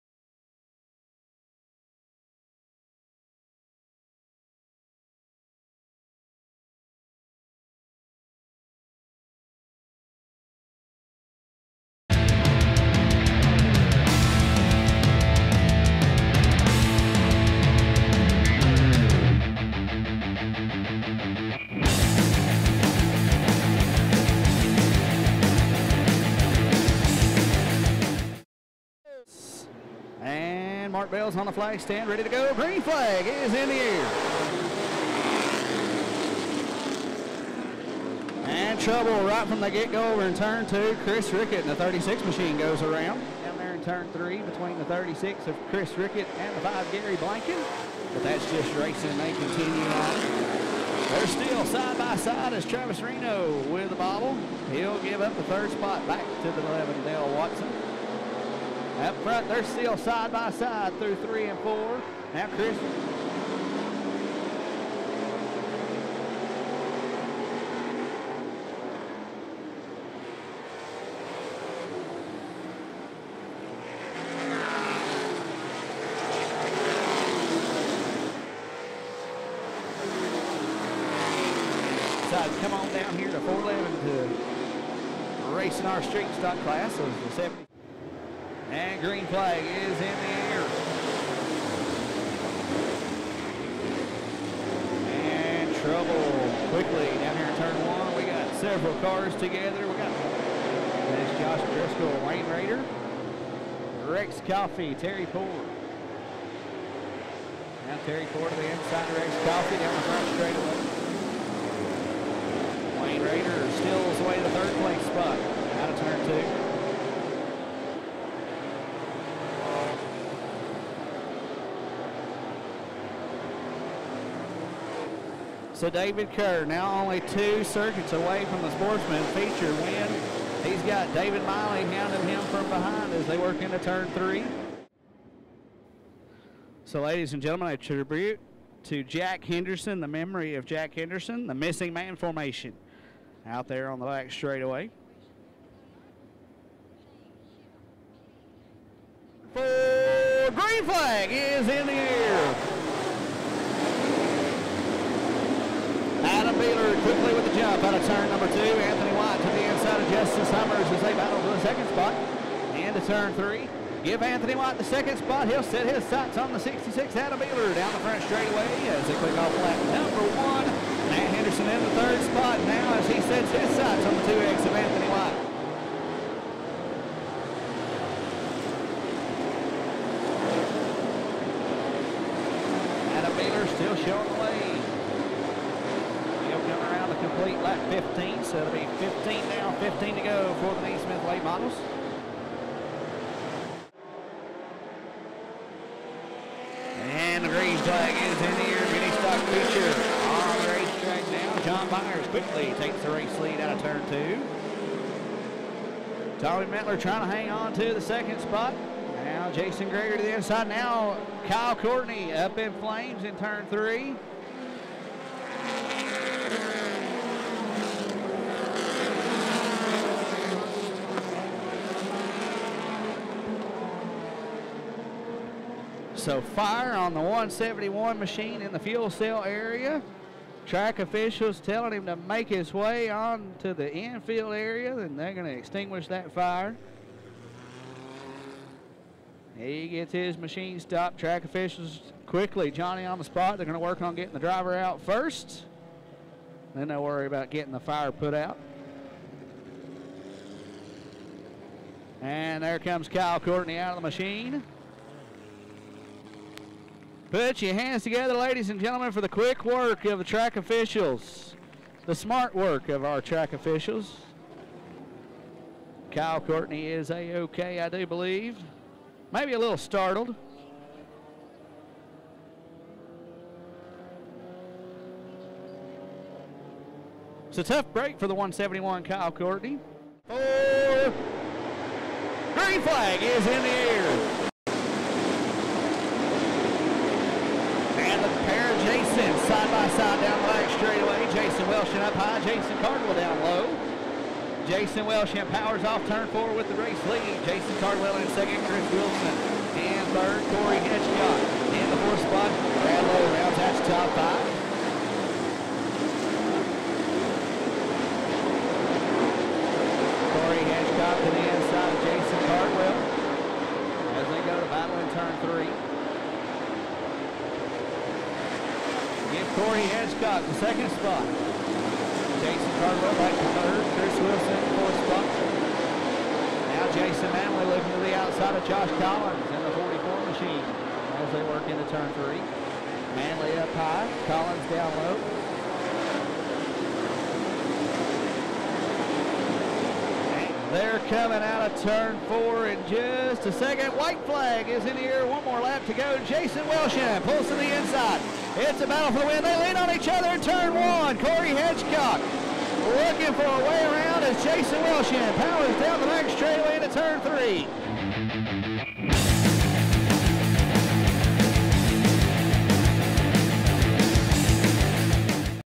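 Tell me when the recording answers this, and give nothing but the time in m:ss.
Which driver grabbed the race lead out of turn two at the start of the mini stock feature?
3:21.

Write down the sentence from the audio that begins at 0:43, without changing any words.
Down there in turn three between the 36 of Chris Rickett and the five Gary Blanken.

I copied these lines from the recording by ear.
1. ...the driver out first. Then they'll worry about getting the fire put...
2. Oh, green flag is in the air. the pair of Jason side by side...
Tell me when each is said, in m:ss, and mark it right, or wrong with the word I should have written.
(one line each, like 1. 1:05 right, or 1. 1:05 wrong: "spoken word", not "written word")
1. 4:04 right
2. 4:40 right.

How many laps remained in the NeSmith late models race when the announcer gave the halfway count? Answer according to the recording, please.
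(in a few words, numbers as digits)
15.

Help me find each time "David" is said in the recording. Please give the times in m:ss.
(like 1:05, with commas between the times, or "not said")
2:05, 2:11.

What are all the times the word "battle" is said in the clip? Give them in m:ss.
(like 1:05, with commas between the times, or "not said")
2:41, 5:14, 5:48.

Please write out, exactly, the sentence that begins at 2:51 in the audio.
Matt Henderson in the third spot now as he sets his sights on the 2X of Anthony Watt.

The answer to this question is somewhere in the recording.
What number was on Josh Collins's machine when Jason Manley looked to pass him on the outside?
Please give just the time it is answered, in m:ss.
5:29.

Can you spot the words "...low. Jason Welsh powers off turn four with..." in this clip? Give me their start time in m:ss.
4:53.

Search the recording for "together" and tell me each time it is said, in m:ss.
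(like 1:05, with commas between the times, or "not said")
1:39, 4:18.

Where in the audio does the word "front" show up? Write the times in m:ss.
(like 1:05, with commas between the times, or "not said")
0:59, 1:50, 2:48.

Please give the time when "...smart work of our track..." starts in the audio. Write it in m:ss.
4:22.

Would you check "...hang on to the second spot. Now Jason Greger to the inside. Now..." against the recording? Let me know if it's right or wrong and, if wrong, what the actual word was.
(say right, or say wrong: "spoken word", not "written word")
right.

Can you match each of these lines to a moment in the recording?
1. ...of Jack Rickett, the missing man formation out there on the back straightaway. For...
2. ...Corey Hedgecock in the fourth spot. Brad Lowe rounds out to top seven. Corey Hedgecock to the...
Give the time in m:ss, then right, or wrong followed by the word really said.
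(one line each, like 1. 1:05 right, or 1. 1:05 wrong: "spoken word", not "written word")
1. 2:20 wrong: "Henderson", not "Rickett"
2. 5:00 wrong: "five", not "seven".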